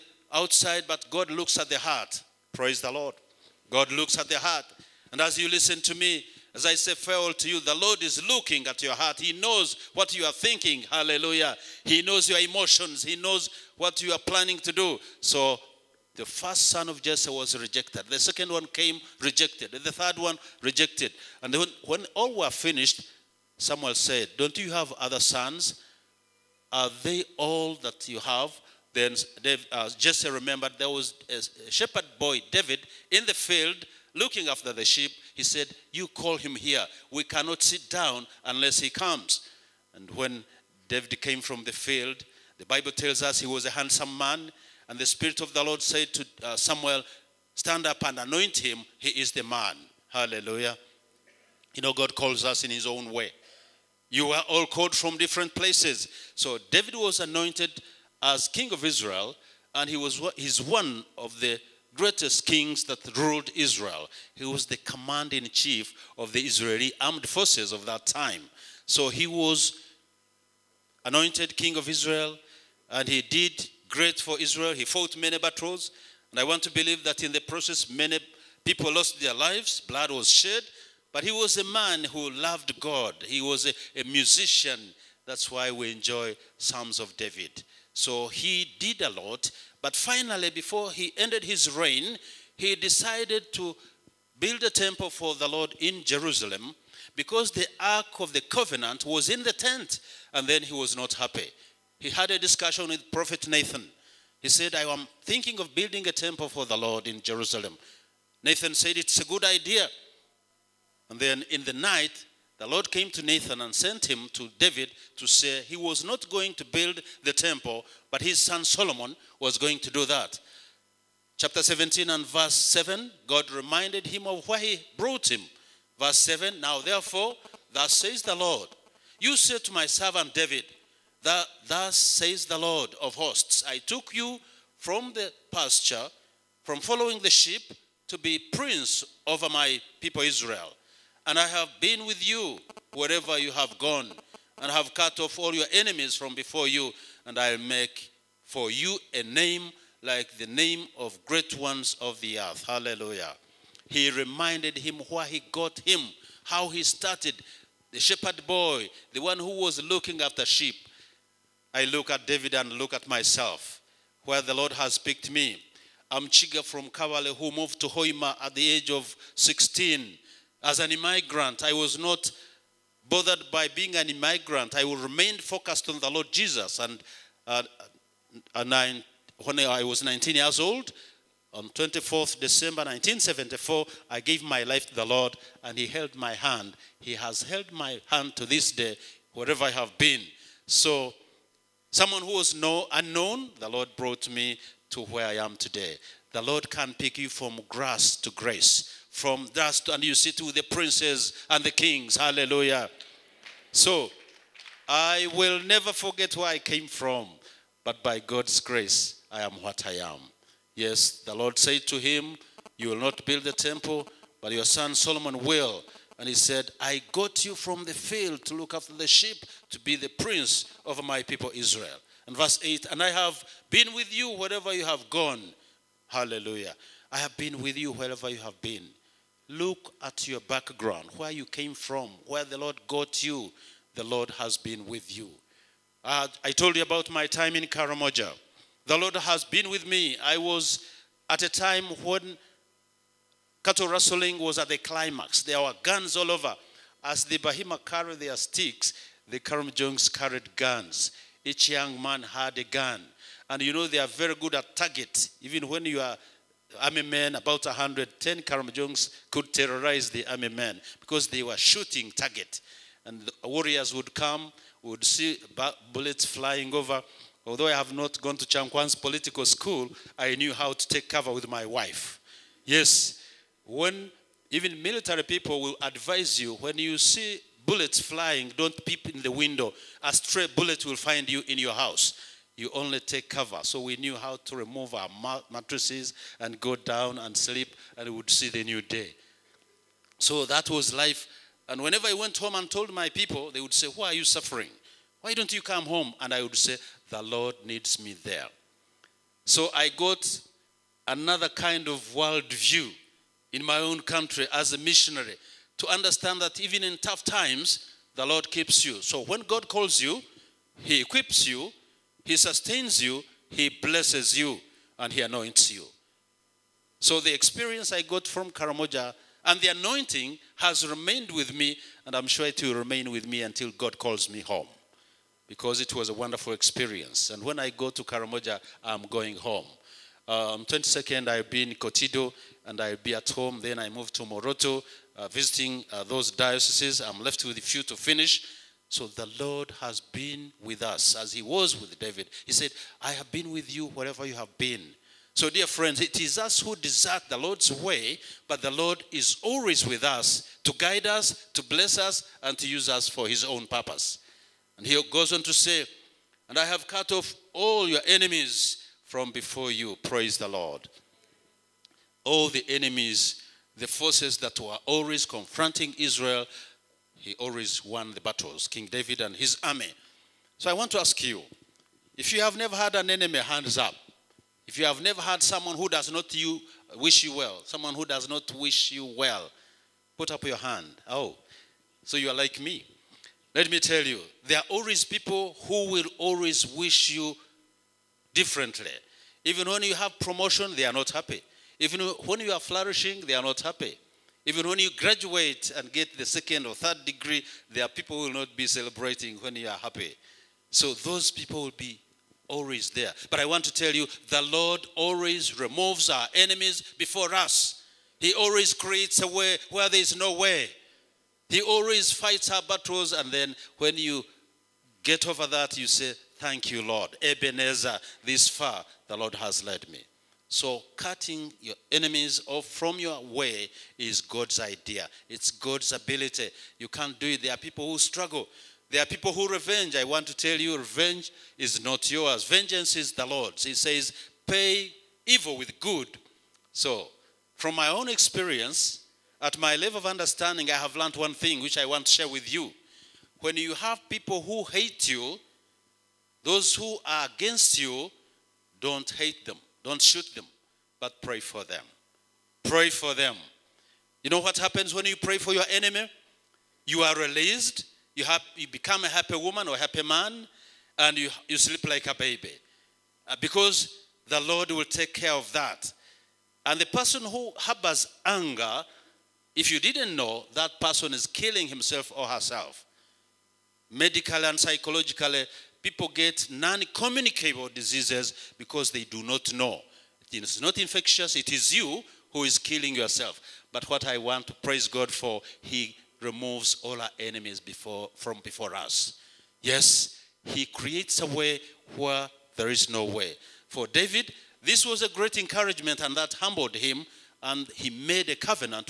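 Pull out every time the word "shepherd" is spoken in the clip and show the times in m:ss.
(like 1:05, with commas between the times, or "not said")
0:31, 2:37.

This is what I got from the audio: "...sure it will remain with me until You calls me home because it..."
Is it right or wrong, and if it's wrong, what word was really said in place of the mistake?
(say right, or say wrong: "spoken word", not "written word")
wrong: "God", not "You".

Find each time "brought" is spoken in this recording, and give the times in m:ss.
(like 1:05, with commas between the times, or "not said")
2:04, 3:13.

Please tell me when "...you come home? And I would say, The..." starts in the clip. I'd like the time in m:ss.
4:55.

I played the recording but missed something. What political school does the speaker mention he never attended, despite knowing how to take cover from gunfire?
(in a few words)
Kyankwanzi.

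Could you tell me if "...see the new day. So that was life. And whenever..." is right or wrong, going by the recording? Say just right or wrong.
right.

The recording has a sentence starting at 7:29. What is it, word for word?
Don't shoot them, but pray for them.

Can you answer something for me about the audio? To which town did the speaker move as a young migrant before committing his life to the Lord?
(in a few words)
Hoima.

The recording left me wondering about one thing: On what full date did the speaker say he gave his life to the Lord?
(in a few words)
24 December 1974.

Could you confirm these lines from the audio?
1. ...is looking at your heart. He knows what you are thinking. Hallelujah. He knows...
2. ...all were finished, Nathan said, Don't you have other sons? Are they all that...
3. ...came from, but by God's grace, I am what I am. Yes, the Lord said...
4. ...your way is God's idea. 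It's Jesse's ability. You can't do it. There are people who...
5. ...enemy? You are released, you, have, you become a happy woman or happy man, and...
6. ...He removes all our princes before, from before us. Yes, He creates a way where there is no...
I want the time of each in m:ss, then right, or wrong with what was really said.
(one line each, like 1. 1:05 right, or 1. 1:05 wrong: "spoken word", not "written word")
1. 0:08 right
2. 0:22 wrong: "Samuel", not "Nathan"
3. 3:26 right
4. 7:02 wrong: "God", not "Jesse"
5. 7:35 right
6. 8:05 wrong: "enemies", not "princes".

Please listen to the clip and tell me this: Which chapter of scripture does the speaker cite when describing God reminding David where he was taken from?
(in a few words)
17.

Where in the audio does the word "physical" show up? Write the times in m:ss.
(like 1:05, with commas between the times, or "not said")
not said.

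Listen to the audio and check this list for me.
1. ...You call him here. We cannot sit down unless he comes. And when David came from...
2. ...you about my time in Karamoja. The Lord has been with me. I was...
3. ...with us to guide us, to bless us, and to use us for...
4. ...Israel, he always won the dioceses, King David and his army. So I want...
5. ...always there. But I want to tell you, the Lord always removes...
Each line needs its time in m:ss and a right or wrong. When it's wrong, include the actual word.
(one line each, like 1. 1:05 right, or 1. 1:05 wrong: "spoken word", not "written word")
1. 0:35 right
2. 3:56 right
3. 5:49 right
4. 6:05 wrong: "battles", not "dioceses"
5. 6:42 right.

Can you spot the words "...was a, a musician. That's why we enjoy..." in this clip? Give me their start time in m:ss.
1:23.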